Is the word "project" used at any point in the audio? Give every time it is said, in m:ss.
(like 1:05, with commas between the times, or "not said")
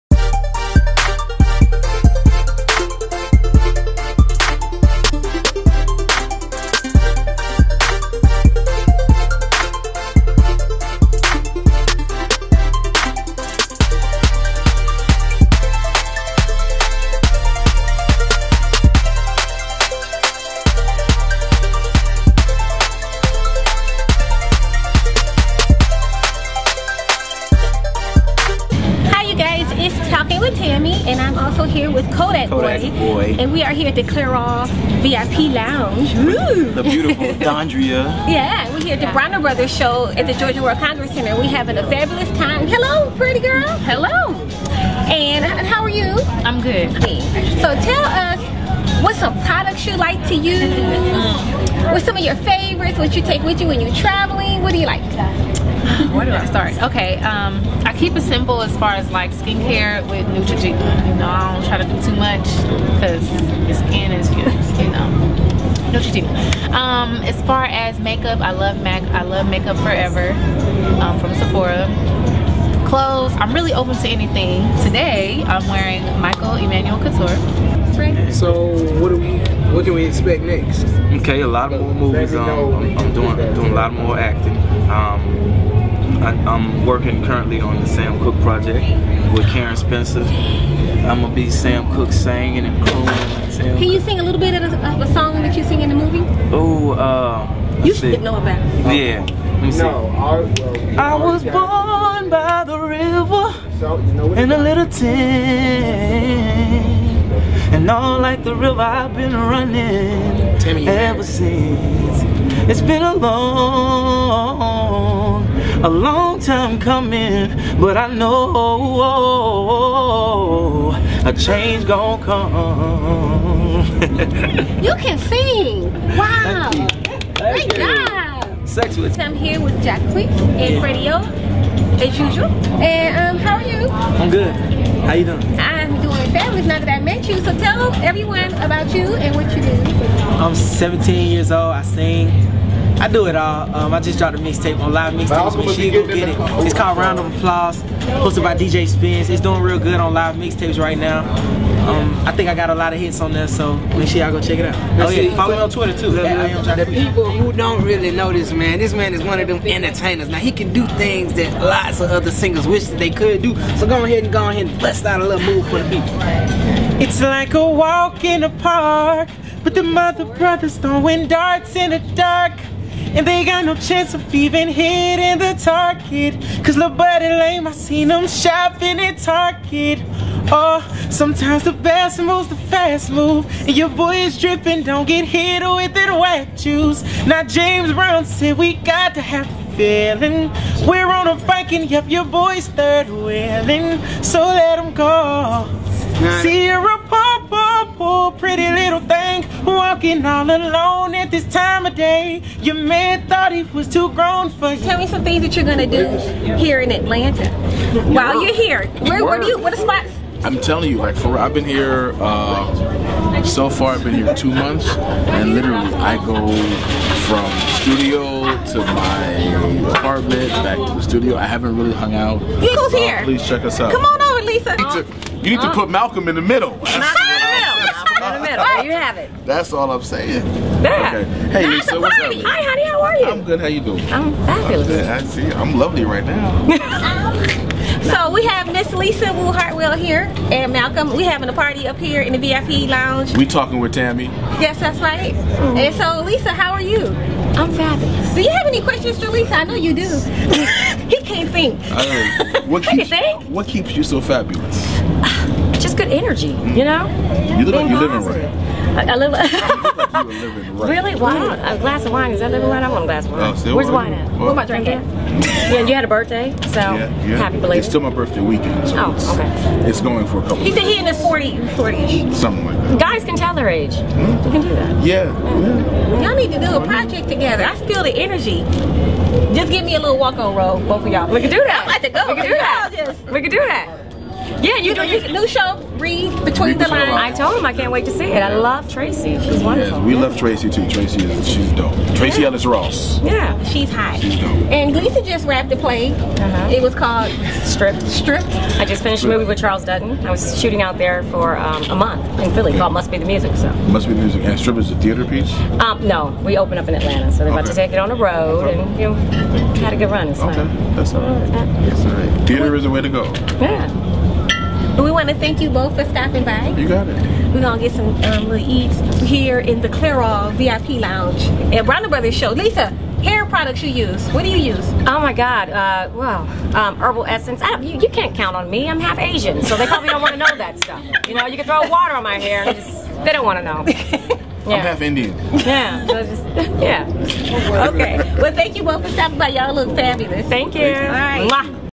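1:28, 4:36.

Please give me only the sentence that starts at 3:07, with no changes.
Now James Brown said we got to have feeling.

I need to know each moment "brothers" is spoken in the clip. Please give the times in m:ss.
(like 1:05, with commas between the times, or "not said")
0:39, 2:50, 5:22.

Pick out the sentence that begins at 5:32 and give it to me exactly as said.
Just, they don't want to know.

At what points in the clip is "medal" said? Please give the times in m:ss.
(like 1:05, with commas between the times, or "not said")
3:48.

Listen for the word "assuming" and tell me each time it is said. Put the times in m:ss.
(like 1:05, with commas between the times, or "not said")
not said.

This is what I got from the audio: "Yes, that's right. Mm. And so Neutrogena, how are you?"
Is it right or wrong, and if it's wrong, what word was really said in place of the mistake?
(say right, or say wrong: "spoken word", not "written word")
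wrong: "Lisa", not "Neutrogena".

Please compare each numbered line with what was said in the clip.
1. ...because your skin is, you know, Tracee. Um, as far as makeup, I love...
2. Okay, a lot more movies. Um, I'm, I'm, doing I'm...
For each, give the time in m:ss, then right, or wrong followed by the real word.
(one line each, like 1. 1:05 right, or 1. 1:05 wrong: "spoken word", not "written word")
1. 1:02 wrong: "Neutrogena", not "Tracee"
2. 1:21 right.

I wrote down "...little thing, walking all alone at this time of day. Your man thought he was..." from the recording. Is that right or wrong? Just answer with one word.
right.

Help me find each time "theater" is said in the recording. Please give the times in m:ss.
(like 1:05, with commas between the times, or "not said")
5:04, 5:12.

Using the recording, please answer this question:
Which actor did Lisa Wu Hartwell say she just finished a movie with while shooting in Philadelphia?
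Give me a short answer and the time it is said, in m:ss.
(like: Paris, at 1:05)
Charles Dutton, at 4:59.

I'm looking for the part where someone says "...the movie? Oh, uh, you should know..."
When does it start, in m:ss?
1:35.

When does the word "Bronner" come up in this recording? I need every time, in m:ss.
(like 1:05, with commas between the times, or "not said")
0:39, 5:21.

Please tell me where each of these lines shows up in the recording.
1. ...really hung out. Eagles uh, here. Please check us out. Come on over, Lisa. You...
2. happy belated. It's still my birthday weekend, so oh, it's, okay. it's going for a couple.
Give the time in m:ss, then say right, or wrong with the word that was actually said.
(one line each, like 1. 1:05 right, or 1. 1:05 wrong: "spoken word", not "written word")
1. 3:41 right
2. 4:27 right.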